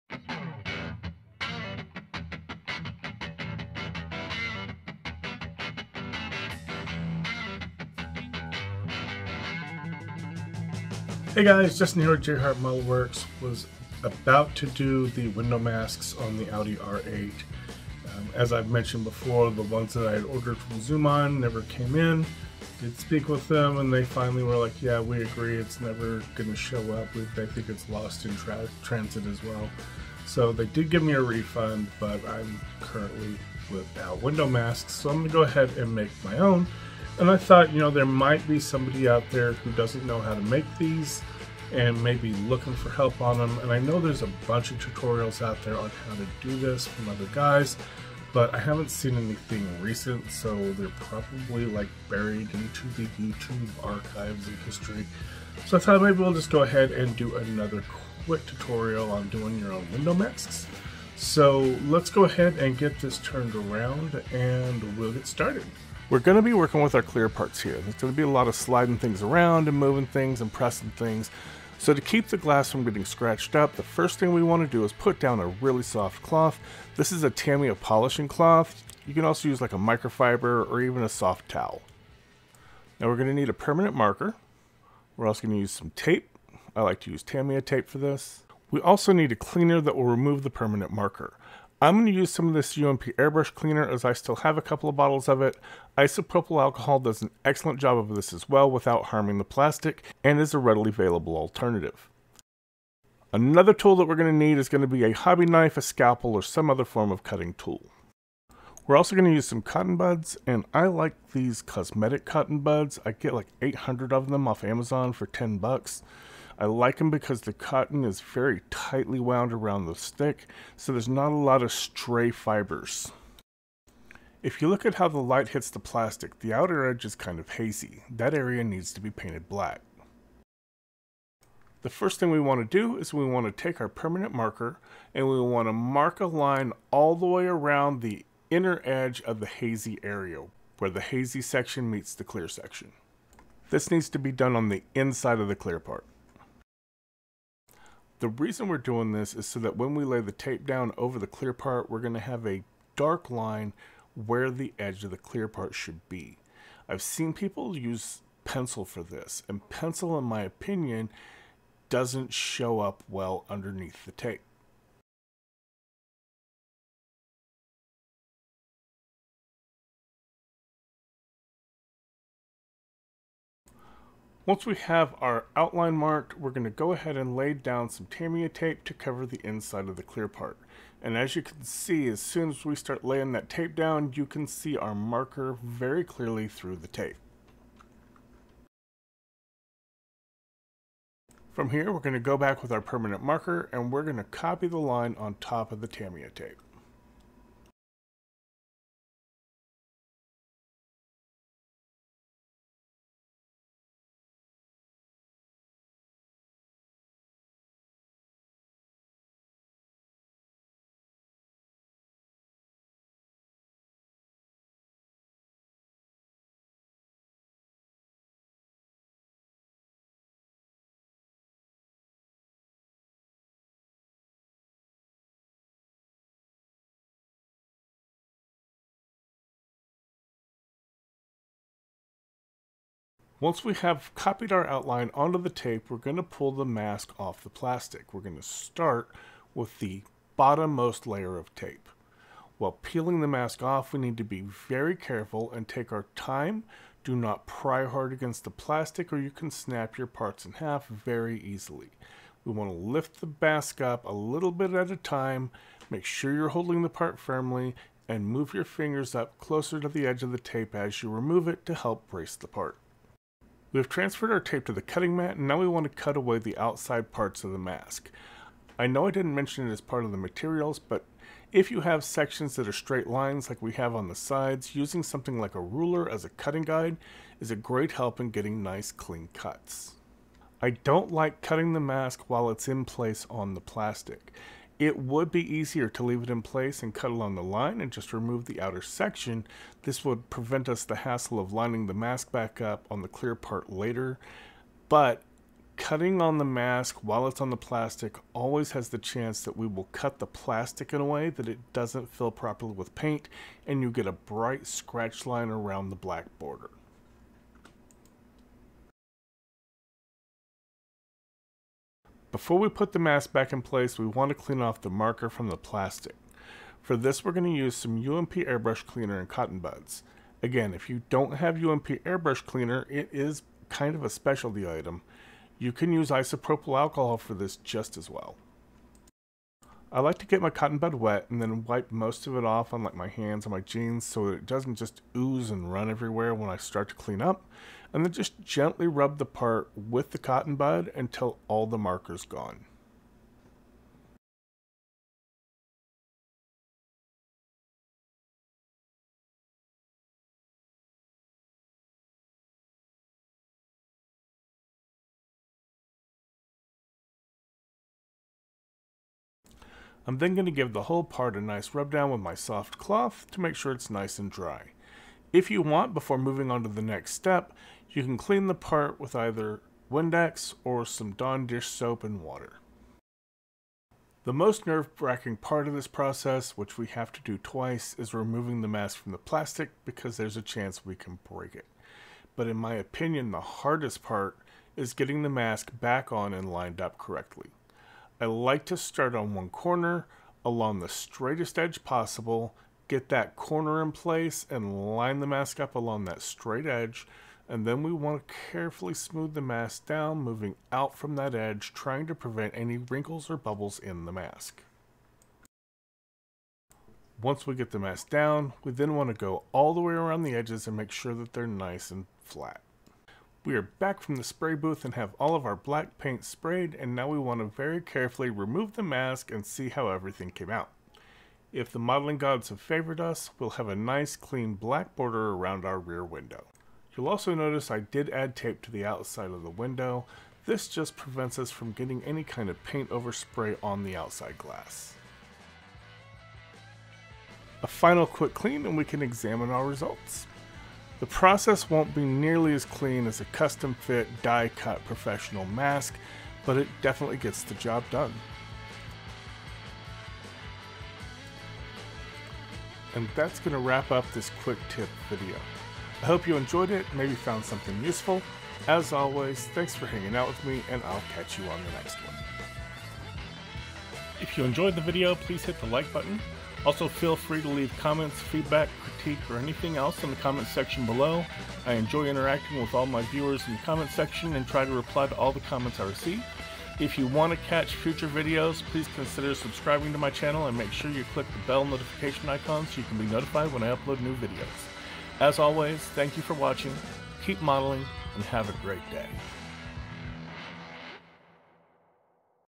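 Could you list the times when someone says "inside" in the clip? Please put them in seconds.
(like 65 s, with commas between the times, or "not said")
144 s, 179 s.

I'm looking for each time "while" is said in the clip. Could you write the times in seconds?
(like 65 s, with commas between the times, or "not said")
242 s, 282 s, 297 s.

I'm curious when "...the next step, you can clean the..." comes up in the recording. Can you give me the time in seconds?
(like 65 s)
366 s.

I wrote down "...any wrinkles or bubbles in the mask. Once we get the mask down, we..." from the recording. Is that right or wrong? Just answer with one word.
right.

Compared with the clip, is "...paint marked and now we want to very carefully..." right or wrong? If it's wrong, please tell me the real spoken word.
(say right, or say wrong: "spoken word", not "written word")
wrong: "sprayed", not "marked".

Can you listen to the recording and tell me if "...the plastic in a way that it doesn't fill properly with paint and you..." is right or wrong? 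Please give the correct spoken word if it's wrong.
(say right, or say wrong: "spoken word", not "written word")
right.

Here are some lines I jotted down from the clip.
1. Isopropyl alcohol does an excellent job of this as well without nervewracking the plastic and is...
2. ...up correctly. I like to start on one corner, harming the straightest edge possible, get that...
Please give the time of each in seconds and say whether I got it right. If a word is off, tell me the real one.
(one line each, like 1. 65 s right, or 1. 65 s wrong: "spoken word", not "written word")
1. 95 s wrong: "harming", not "nervewracking"
2. 386 s wrong: "along", not "harming".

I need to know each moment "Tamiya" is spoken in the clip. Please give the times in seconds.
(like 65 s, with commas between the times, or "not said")
77 s, 87 s, 178 s, 195 s.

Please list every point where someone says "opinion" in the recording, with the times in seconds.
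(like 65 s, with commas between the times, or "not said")
160 s, 382 s.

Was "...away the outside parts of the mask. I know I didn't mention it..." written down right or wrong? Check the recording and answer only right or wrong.
right.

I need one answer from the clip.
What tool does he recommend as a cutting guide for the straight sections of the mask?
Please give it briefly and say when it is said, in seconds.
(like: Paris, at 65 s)
A ruler, at 275 s.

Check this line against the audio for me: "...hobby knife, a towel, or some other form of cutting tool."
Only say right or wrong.
wrong.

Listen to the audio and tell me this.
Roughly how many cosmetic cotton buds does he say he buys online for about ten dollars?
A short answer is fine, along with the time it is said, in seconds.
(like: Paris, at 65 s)
800, at 113 s.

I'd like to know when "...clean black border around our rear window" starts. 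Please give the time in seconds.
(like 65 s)
424 s.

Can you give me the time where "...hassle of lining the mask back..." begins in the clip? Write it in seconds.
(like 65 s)
290 s.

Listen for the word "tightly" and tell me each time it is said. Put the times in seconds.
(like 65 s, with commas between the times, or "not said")
118 s.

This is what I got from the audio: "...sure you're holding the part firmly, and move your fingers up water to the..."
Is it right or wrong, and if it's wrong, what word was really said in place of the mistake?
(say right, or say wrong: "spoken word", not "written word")
wrong: "closer", not "water".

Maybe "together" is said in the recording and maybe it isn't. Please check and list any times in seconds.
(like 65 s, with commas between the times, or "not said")
not said.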